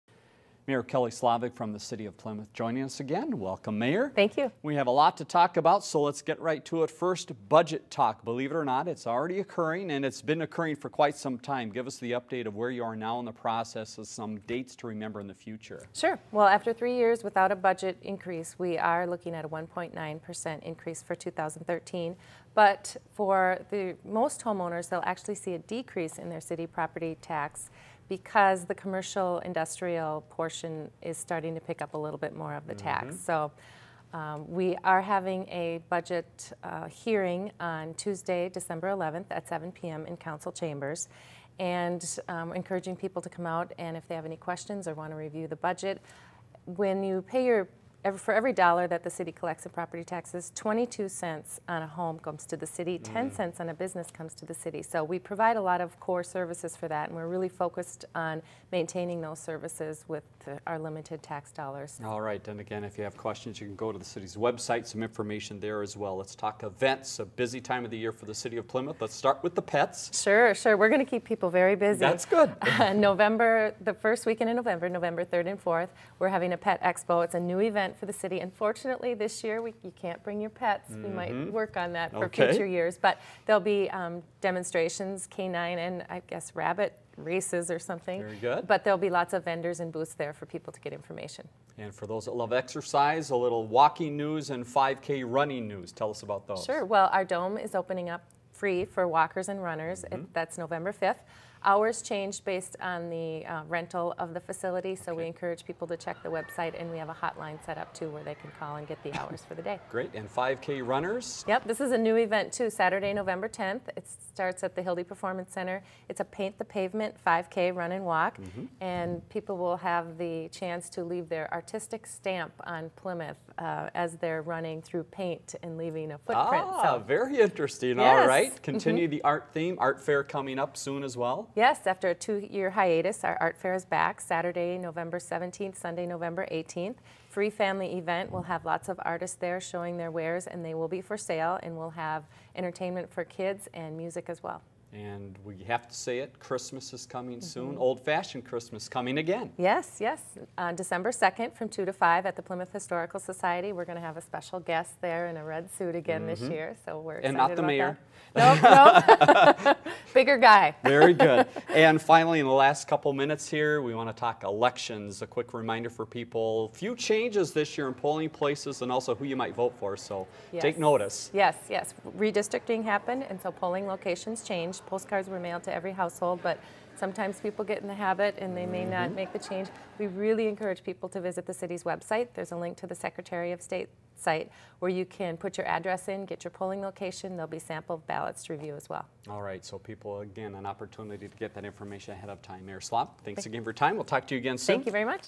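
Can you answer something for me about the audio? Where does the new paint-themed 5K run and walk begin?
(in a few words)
Hilde Performance Center.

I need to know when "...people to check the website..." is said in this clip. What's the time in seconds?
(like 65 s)
105 s.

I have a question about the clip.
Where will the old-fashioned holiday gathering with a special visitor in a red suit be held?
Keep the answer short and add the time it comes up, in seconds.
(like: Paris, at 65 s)
Plymouth Historical Society, at 152 s.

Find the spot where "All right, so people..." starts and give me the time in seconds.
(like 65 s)
189 s.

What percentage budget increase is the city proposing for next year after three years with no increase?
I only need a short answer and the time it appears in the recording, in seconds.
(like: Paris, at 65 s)
1.9%, at 19 s.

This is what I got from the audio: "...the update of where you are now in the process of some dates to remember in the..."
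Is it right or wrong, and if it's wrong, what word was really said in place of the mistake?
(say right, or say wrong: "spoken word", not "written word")
right.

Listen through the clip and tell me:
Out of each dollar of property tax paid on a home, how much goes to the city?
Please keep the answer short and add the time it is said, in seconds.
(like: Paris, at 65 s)
22 cents, at 50 s.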